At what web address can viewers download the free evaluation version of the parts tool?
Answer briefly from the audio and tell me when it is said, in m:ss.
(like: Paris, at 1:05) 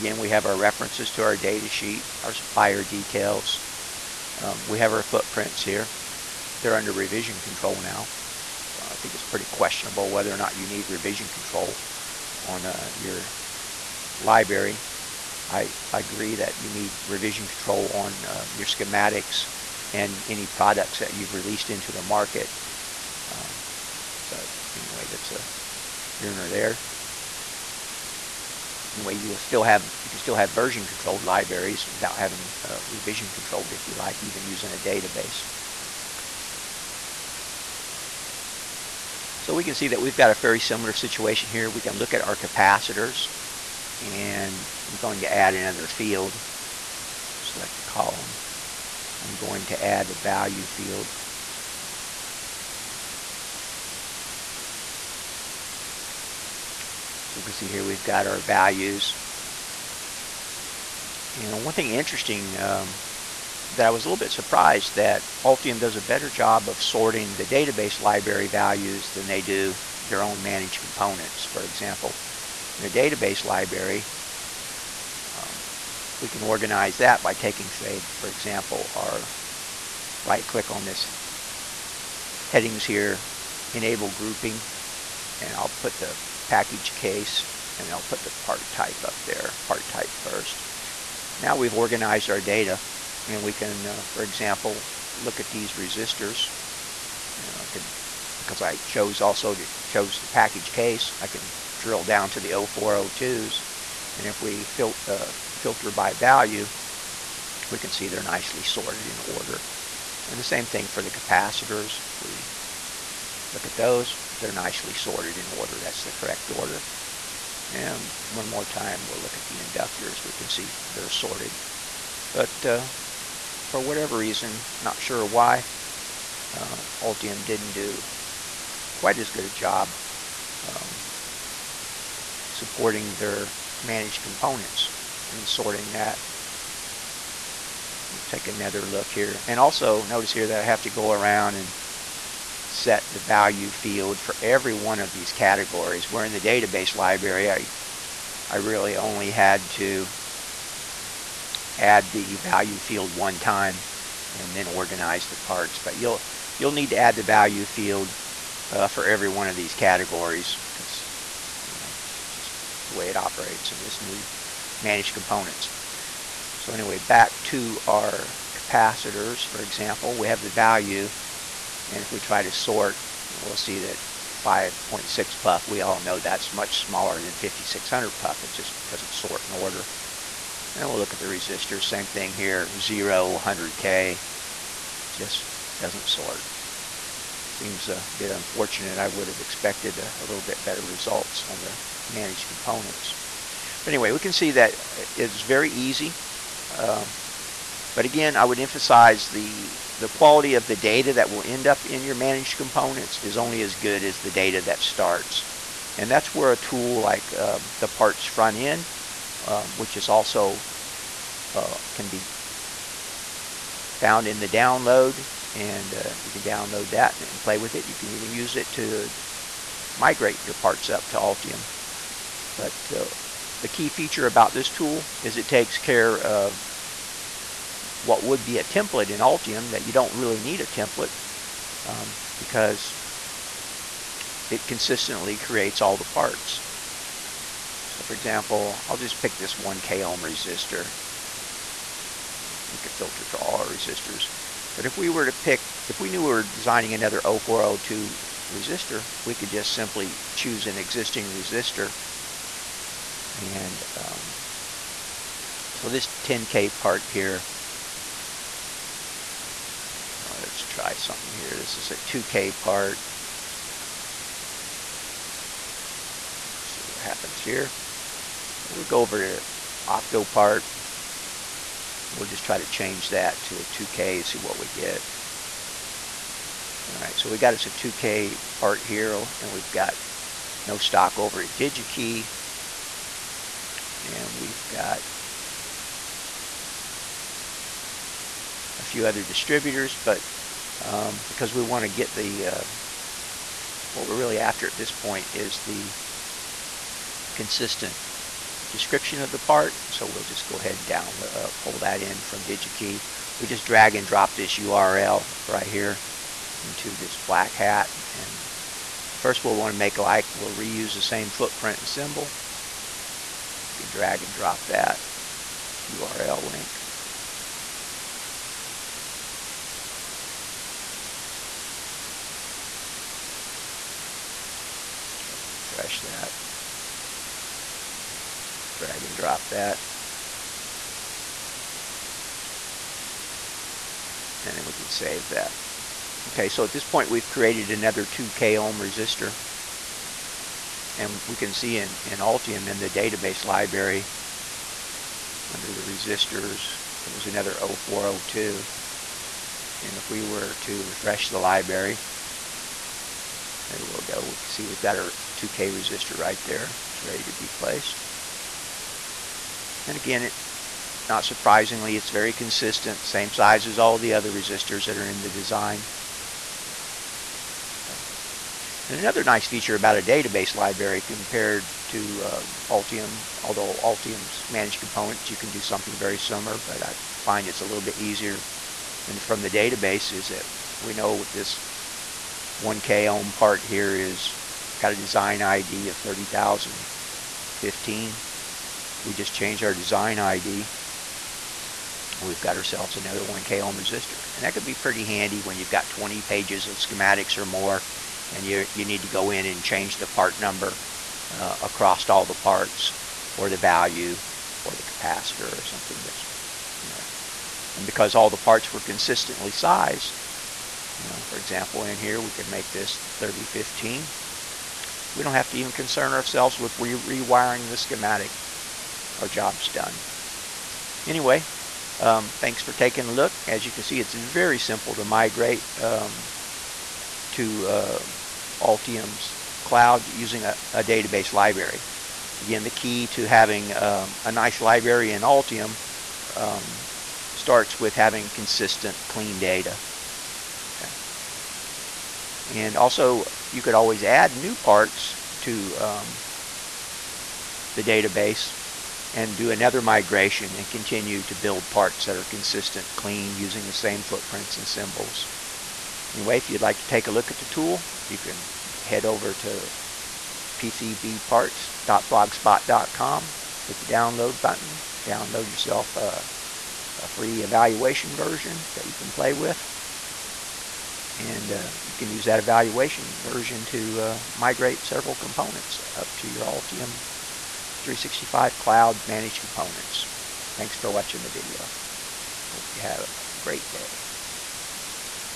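pcbparts.blogspot.com, at 7:40.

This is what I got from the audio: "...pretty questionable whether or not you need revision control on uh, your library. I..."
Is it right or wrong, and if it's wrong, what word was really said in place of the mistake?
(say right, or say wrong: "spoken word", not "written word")
right.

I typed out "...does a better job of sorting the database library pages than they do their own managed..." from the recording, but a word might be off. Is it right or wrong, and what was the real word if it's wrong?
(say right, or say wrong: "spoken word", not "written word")
wrong: "values", not "pages".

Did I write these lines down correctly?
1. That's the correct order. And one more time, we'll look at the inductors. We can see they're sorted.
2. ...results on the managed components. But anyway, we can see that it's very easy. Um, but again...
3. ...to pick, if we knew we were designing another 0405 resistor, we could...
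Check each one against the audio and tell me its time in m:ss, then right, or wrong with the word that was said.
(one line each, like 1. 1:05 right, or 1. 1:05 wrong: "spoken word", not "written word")
1. 1:55 right
2. 3:10 right
3. 4:05 wrong: "0402", not "0405".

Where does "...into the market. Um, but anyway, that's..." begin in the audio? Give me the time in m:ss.
0:21.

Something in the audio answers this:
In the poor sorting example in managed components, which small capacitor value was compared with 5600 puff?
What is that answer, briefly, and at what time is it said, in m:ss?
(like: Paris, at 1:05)
5.6 puff, at 2:54.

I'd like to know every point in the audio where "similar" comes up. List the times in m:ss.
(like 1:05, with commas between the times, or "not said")
0:40, 6:16.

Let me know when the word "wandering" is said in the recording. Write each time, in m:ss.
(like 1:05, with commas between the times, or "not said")
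not said.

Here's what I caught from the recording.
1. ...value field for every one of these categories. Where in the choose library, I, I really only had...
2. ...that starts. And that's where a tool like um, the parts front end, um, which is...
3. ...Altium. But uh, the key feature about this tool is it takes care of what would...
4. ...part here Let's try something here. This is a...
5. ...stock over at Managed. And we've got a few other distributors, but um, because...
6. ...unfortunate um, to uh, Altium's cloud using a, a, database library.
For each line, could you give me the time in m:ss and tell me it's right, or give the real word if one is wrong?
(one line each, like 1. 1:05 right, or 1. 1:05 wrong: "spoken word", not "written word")
1. 2:23 wrong: "database", not "choose"
2. 3:24 right
3. 3:41 right
4. 4:16 right
5. 4:40 wrong: "DigiKey", not "Managed"
6. 7:05 wrong: "migrate", not "unfortunate".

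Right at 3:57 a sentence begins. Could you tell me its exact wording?
So for example, I'll just pick this 1 k ohm resistor.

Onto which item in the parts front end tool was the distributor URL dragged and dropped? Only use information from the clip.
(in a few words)
black hat.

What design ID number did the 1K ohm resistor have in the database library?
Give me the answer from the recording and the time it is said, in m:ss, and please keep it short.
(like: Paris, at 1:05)
30015, at 6:25.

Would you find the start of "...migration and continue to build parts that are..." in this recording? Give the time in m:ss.
7:29.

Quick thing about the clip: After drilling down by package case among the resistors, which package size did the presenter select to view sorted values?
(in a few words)
0402.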